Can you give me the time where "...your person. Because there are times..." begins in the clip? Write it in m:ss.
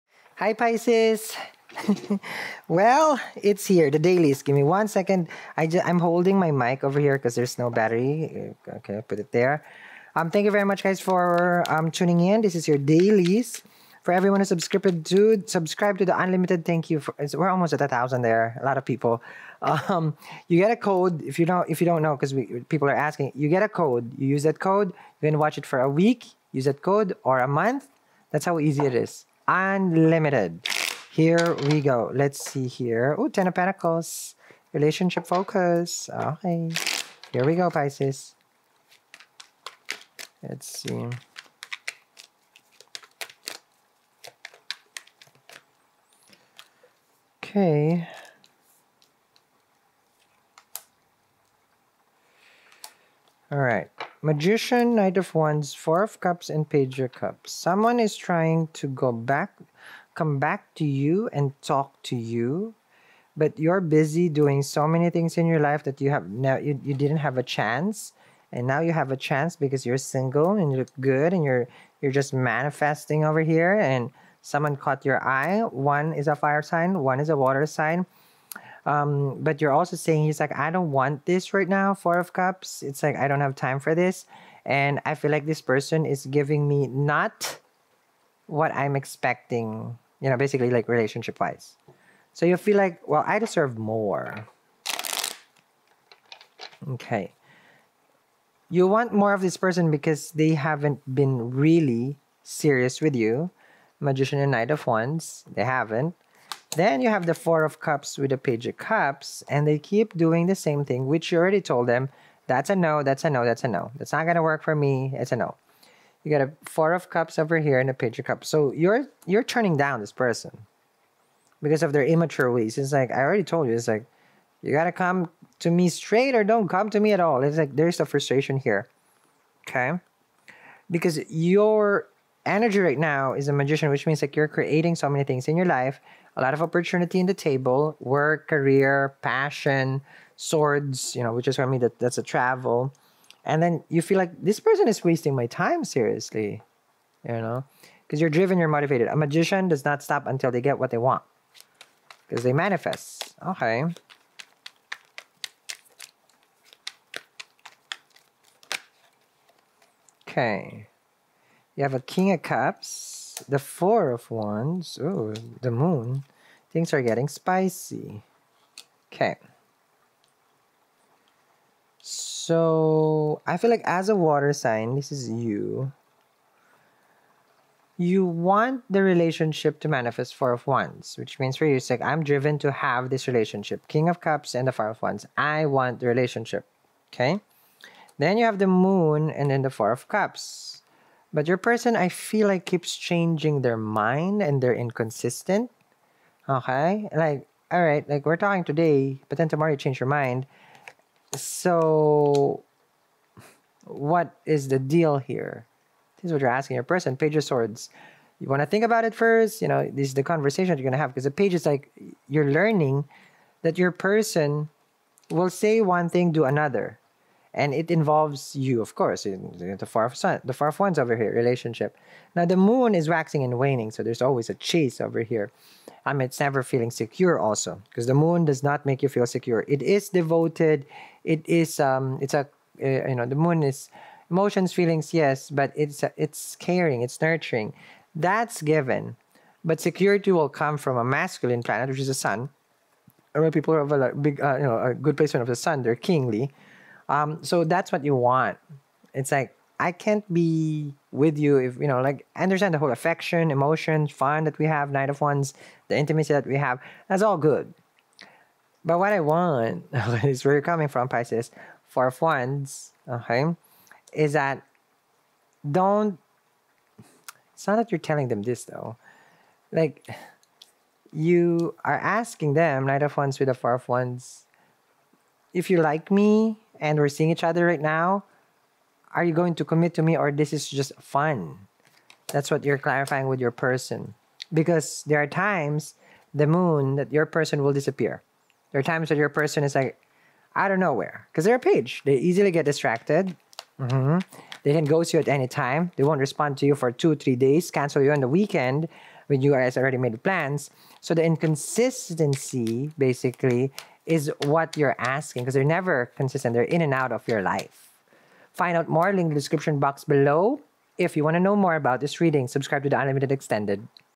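4:43.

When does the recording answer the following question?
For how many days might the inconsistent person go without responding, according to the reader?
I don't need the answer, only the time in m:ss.
4:56.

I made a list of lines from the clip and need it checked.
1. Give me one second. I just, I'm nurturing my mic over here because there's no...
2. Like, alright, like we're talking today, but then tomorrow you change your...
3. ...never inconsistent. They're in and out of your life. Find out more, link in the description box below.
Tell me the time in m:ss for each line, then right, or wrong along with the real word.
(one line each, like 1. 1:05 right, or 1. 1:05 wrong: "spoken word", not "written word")
1. 0:04 wrong: "holding", not "nurturing"
2. 3:17 right
3. 5:05 wrong: "consistent", not "inconsistent".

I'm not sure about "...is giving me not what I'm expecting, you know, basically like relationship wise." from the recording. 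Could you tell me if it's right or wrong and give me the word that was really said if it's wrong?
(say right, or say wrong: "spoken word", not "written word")
right.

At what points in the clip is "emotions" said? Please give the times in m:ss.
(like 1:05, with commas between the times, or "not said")
3:54, 4:13.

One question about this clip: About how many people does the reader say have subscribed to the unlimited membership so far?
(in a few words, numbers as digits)
Almost 1000.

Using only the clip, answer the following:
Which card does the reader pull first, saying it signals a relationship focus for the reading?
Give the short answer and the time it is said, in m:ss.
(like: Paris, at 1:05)
Ten of Pentacles, at 0:33.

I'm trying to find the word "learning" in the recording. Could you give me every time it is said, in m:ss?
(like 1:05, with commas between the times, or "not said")
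3:32.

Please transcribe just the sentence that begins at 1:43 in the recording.
Magician and Knight of Wands, they haven't.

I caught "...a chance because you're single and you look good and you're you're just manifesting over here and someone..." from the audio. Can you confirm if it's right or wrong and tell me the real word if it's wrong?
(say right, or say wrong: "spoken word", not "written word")
right.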